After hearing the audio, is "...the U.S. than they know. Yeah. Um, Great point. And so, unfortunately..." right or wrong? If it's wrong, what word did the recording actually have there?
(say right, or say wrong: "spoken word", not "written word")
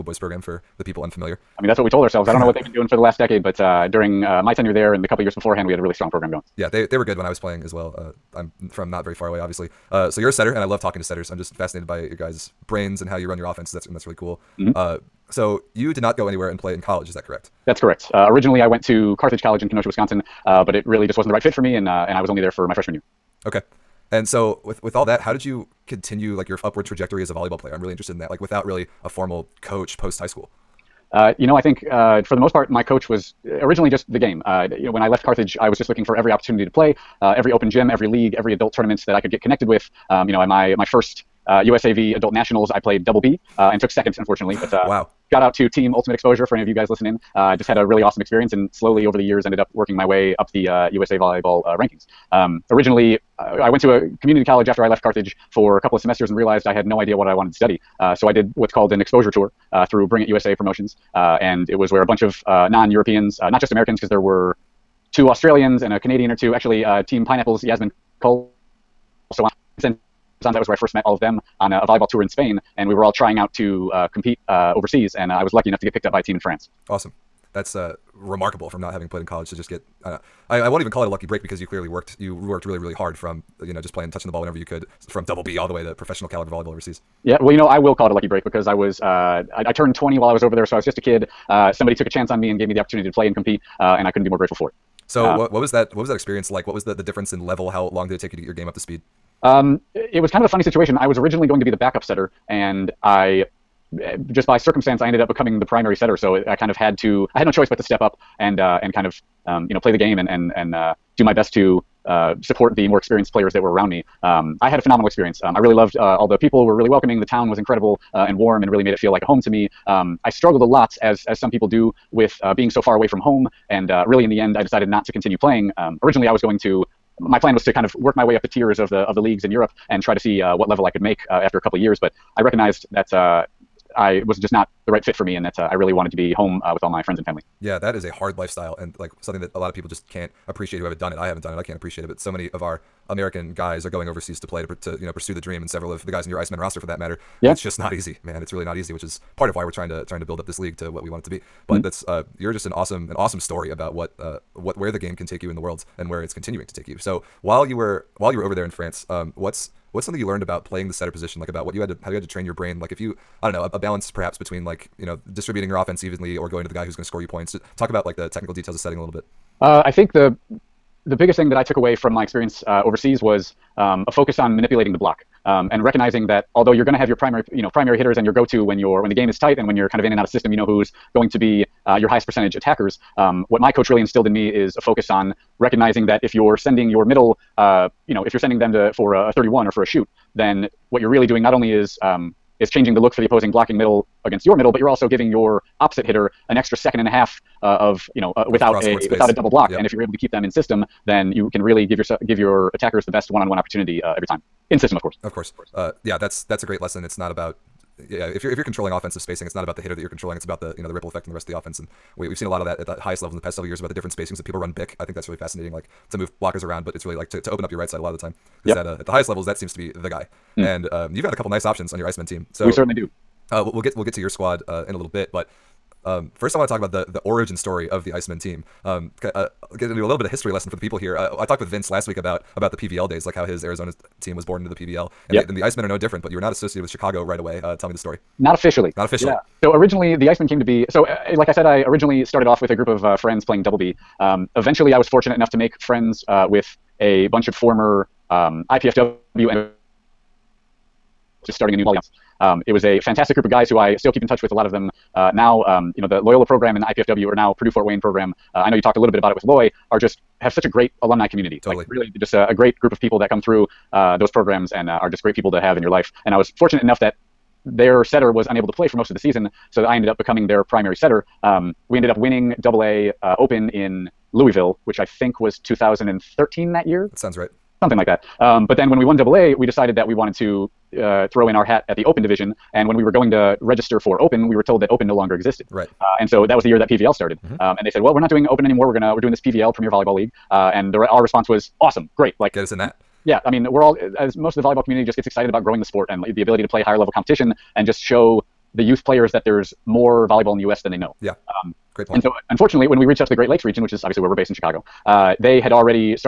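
right.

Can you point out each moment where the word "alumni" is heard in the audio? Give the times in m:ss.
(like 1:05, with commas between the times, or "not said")
4:21.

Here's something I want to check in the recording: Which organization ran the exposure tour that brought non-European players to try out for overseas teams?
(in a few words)
Bring It USA Promotions.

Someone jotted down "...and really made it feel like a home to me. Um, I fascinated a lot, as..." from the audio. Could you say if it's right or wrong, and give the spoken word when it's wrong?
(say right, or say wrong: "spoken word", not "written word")
wrong: "struggled", not "fascinated".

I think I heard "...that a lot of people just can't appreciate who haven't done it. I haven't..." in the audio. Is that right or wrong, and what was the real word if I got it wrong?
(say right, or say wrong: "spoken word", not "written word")
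right.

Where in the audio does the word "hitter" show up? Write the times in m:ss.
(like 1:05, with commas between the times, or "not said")
2:57, 3:16, 3:29.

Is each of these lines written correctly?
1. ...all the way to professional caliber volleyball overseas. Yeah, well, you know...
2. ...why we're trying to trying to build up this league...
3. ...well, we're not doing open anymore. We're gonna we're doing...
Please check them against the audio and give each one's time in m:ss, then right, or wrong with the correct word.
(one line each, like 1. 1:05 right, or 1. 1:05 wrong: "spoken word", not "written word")
1. 1:25 right
2. 2:29 right
3. 4:47 right.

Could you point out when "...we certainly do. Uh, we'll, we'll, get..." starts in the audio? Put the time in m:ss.
3:42.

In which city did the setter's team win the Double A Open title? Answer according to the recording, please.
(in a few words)
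Louisville.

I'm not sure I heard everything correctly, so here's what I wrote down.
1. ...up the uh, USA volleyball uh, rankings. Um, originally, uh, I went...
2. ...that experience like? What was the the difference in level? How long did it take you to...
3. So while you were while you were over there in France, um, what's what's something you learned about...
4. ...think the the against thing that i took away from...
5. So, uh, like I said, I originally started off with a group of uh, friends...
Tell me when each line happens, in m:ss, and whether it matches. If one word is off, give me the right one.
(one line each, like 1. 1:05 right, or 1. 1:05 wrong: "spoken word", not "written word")
1. 0:50 right
2. 1:36 right
3. 2:36 right
4. 2:49 wrong: "biggest", not "against"
5. 4:00 right.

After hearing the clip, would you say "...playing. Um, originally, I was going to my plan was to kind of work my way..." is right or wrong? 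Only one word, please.
right.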